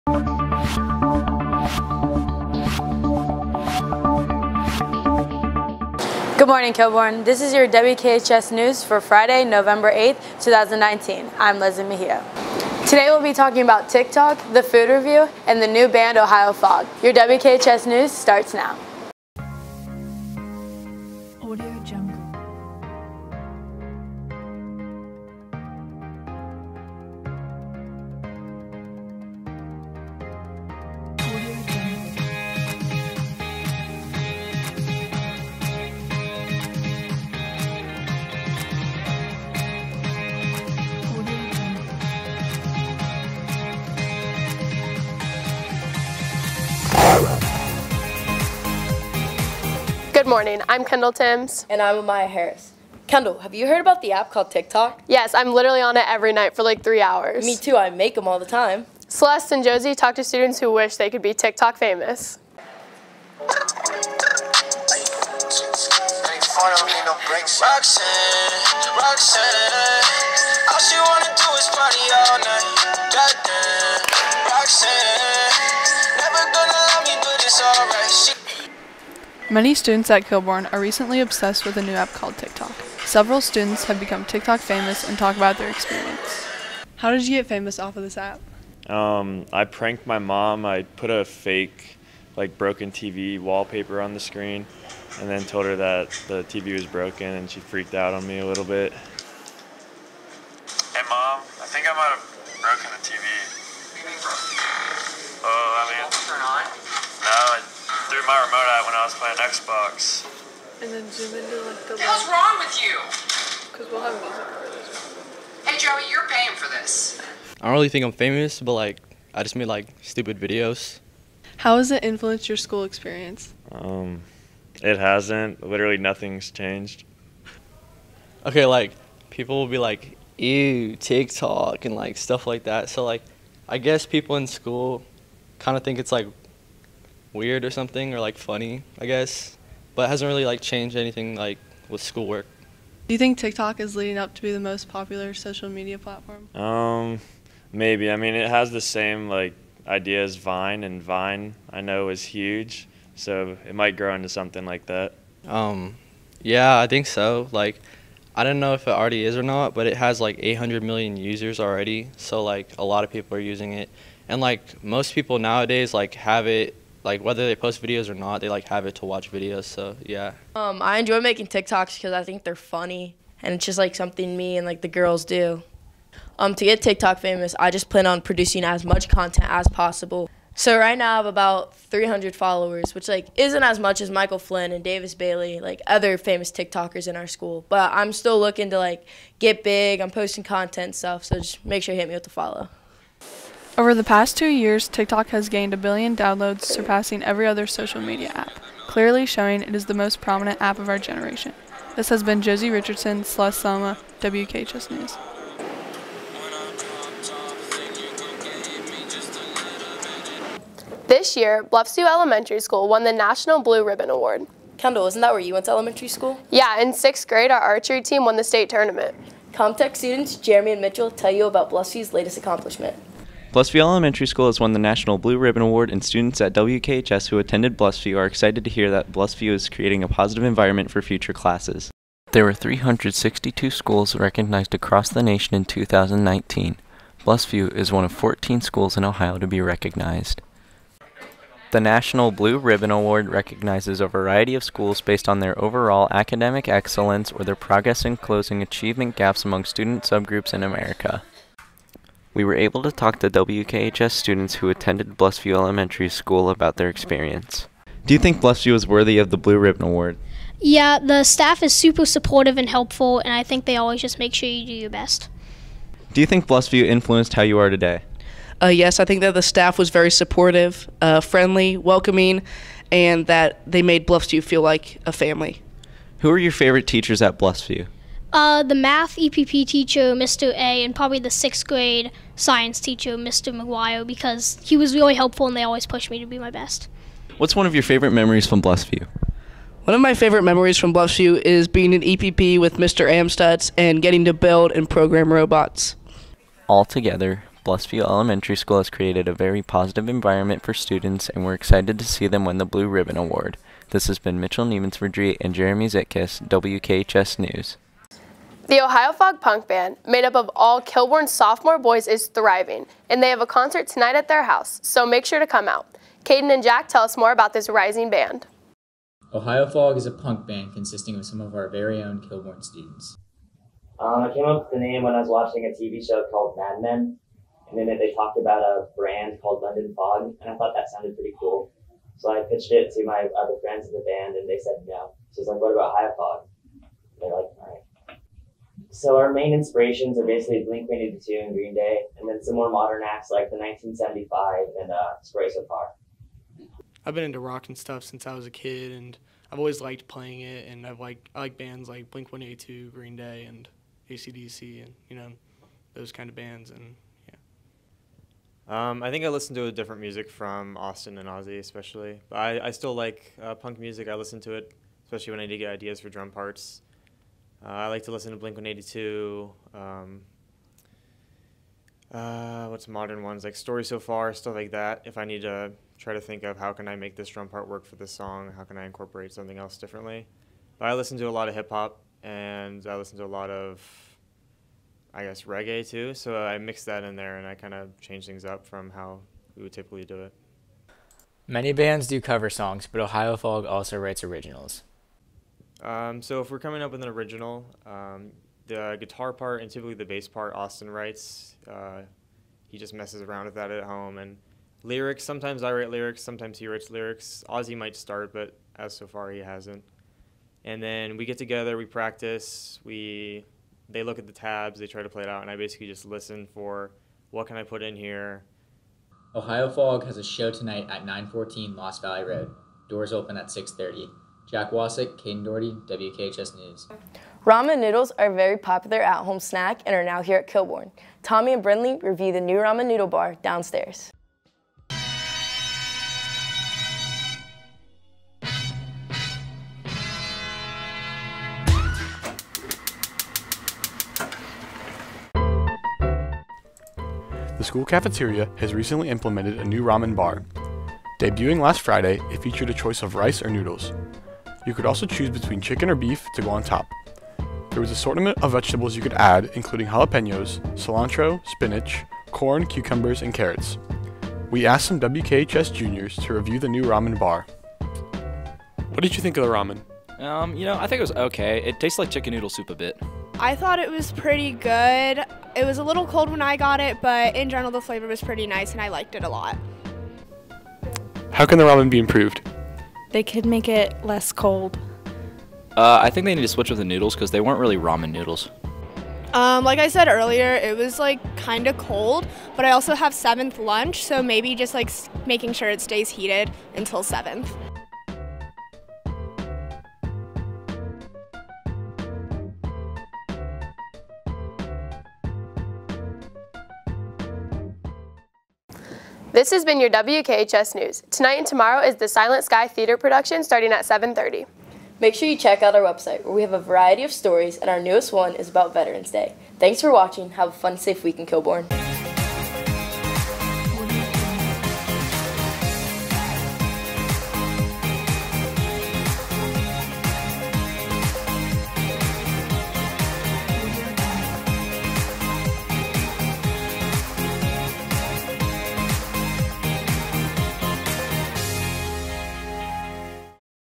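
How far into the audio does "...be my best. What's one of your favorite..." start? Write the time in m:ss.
4:46.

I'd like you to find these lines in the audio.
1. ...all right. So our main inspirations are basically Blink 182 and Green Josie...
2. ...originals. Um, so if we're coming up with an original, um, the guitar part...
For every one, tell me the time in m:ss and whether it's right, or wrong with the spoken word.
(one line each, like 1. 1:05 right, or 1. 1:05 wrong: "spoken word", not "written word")
1. 5:37 wrong: "Day", not "Josie"
2. 6:34 right.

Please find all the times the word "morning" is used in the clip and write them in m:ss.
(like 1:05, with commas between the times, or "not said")
0:06, 0:50.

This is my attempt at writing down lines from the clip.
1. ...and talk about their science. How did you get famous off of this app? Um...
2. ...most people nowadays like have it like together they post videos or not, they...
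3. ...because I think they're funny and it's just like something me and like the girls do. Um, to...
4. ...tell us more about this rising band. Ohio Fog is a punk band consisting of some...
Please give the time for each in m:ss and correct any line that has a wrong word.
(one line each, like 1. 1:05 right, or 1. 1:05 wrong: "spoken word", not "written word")
1. 1:25 wrong: "experience", not "science"
2. 2:44 wrong: "whether", not "together"
3. 2:51 right
4. 5:16 right.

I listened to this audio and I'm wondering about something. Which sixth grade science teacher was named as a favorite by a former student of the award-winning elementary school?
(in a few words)
Mr. McGuire.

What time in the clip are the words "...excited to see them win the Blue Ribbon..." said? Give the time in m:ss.
5:01.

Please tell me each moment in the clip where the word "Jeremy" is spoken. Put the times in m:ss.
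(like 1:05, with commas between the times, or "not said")
3:40, 5:05.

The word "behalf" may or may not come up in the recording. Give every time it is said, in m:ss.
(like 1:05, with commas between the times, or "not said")
not said.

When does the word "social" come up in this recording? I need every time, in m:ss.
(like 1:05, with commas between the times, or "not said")
2:25, 3:17.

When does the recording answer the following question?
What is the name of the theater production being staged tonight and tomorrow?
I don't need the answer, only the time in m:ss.
8:32.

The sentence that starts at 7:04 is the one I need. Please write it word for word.
Jack Wasick, Caden Doherty, WKHS News.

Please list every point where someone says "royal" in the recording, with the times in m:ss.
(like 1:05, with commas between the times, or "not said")
not said.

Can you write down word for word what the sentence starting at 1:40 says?
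Hey, Mom, I think I might have broken the TV.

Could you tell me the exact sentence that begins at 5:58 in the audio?
Um, I think I listen to different music from Austin and Ozzy, especially.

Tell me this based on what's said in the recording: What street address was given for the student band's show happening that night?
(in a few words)
914 Lost Valley Road.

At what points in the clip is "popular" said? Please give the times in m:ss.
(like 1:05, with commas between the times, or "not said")
2:24, 7:08.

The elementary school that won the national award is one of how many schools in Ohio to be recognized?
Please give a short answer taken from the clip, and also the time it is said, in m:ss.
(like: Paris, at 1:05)
14, at 3:58.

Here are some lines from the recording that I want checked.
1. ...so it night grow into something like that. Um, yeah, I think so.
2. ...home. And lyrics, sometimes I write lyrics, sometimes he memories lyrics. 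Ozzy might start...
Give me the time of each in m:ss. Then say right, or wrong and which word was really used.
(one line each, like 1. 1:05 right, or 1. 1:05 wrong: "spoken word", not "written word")
1. 2:33 wrong: "might", not "night"
2. 6:43 wrong: "writes", not "memories".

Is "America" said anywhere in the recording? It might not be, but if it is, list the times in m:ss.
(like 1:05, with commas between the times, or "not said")
4:10.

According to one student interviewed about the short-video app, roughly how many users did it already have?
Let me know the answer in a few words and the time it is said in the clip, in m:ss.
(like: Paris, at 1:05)
800 million, at 2:40.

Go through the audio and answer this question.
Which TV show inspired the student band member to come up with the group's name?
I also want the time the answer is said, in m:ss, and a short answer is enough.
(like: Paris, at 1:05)
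Mad Men, at 5:26.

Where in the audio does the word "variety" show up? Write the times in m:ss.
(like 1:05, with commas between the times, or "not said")
4:04, 8:36.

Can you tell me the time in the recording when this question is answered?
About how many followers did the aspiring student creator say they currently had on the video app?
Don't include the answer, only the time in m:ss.
3:01.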